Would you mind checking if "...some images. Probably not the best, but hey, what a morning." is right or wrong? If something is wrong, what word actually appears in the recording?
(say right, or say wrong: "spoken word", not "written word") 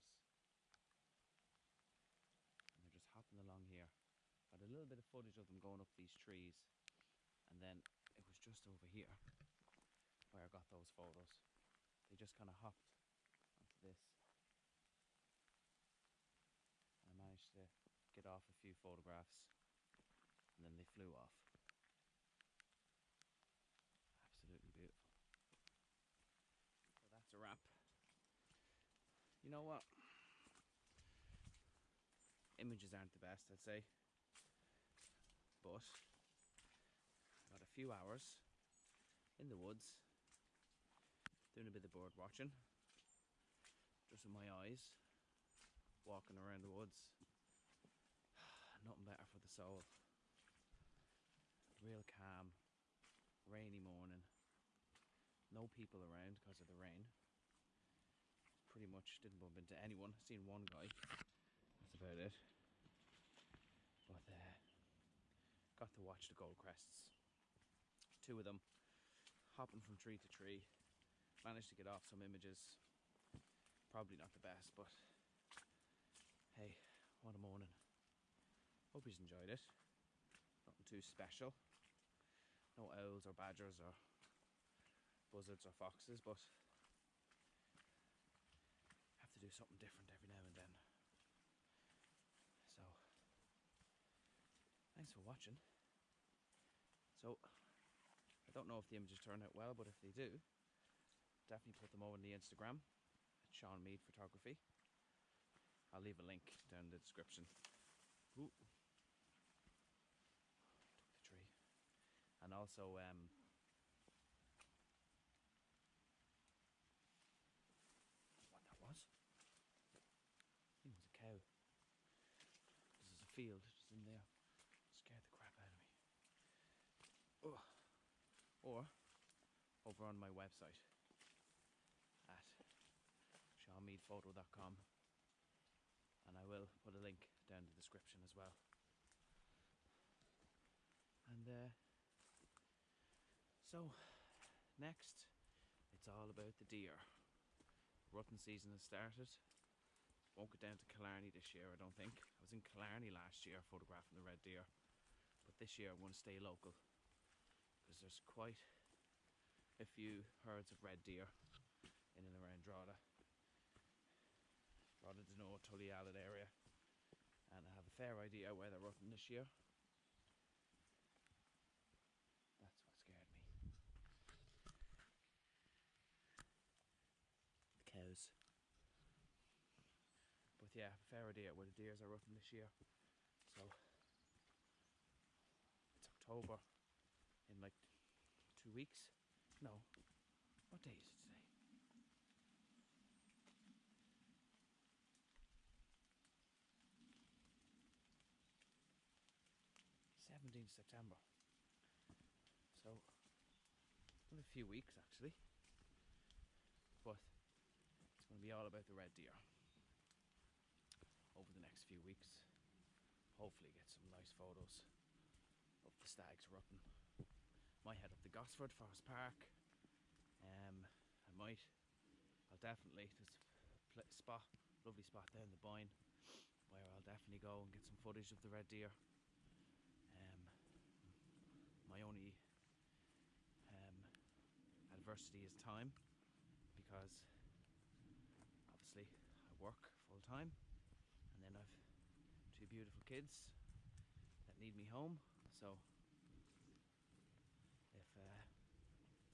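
right.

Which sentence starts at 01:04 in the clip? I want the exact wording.
But uh, got to watch the gold crests.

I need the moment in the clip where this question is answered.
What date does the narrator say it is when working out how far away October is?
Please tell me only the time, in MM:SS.
03:20.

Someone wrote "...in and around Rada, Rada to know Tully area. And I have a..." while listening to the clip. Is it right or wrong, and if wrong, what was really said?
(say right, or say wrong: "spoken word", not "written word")
right.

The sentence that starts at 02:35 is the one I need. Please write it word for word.
But this year I'm going to stay local.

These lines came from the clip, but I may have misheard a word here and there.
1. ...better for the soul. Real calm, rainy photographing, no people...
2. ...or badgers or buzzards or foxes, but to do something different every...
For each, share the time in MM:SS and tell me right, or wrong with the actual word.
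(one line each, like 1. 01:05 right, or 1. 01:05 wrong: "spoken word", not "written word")
1. 00:49 wrong: "morning", not "photographing"
2. 01:23 right.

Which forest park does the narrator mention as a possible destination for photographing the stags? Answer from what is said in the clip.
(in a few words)
Gosford Forest Park.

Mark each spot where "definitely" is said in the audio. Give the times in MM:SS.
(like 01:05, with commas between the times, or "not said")
01:41, 03:42, 03:47.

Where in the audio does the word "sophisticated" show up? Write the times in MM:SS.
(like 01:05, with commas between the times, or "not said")
not said.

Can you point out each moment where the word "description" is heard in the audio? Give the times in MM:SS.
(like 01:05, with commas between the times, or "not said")
01:46, 02:17.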